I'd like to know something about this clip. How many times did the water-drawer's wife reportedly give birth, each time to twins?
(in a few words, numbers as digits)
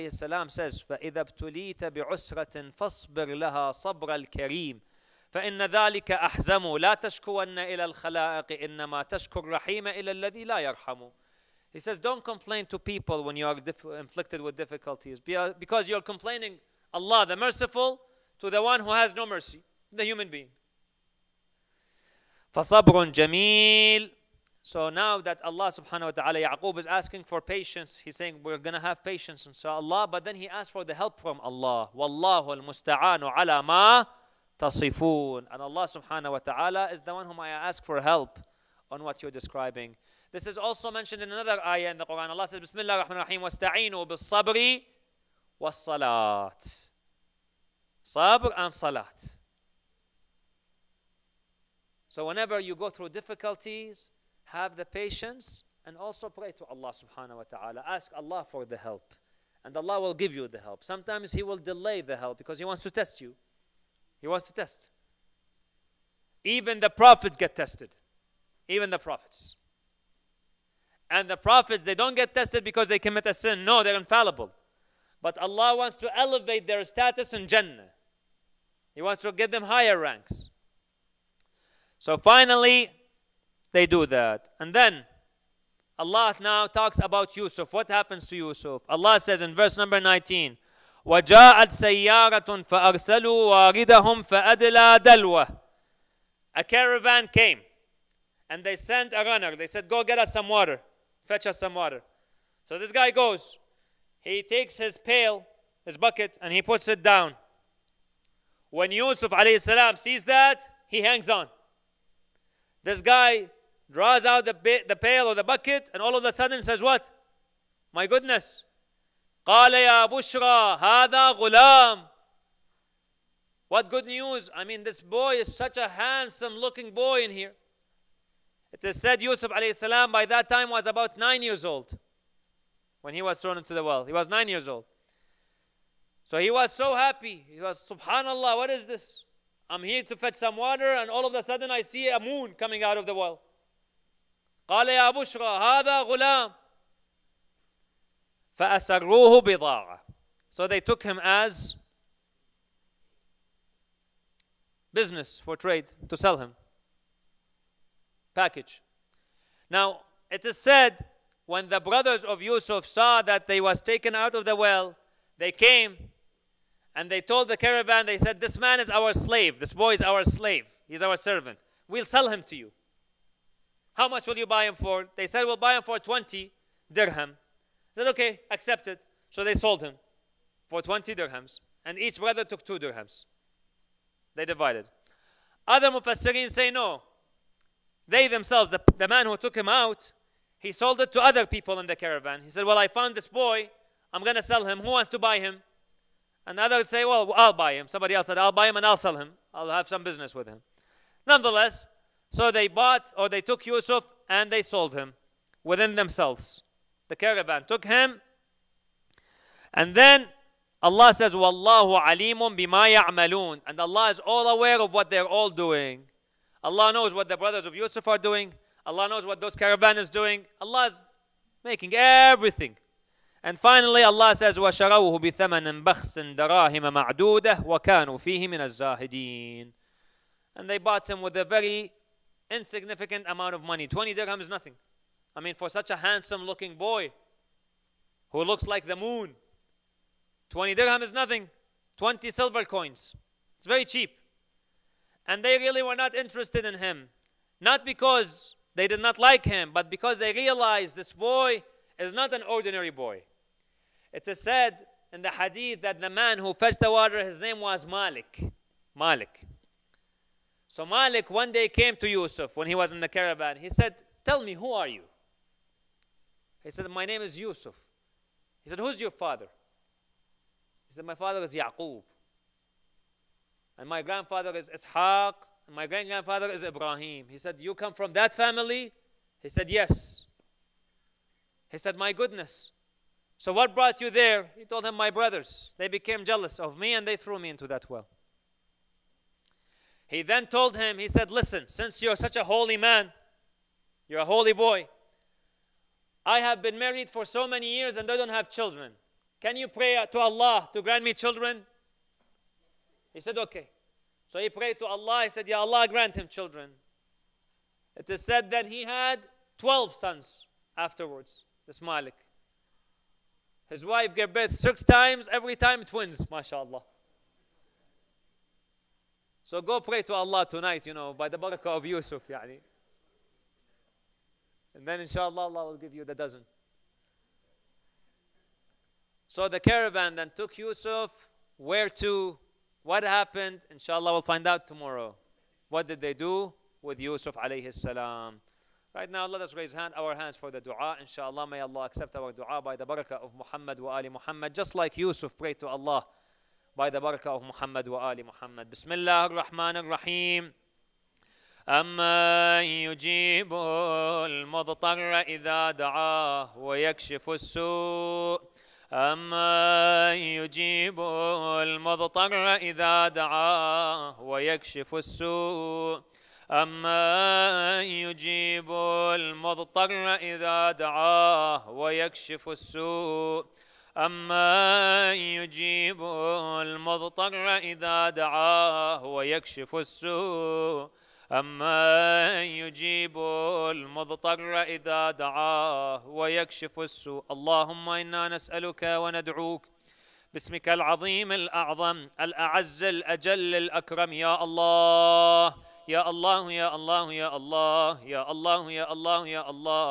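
6.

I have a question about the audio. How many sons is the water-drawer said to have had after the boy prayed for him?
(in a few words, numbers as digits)
12.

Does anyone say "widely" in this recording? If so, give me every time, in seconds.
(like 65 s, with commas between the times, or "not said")
not said.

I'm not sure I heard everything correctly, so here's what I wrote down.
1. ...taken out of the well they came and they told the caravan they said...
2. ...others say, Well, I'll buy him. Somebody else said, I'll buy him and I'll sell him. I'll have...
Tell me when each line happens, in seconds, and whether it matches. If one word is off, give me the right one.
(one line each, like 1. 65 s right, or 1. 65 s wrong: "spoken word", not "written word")
1. 163 s right
2. 196 s right.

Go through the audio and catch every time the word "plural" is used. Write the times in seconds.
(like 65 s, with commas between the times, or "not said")
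not said.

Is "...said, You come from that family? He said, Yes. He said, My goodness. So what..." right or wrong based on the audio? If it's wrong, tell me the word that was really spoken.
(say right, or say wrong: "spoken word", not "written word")
right.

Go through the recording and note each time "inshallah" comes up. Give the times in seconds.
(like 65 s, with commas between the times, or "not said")
325 s, 333 s, 341 s.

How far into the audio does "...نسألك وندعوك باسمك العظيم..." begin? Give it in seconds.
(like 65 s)
388 s.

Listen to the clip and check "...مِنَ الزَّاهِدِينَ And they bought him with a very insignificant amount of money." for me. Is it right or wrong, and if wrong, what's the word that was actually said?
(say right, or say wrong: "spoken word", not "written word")
right.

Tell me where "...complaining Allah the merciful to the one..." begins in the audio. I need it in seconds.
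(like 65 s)
16 s.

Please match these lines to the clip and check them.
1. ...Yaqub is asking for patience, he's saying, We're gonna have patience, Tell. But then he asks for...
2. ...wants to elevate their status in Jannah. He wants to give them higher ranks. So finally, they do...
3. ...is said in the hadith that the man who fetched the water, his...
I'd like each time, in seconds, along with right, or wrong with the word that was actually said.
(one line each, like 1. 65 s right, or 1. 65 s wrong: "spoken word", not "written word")
1. 26 s wrong: "Allah", not "Tell"
2. 75 s right
3. 254 s right.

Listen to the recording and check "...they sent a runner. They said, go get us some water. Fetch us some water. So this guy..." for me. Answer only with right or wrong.
right.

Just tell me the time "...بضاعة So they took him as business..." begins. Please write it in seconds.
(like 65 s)
149 s.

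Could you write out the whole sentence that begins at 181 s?
And each brother took two dirhams.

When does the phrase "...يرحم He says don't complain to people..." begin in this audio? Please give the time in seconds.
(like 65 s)
10 s.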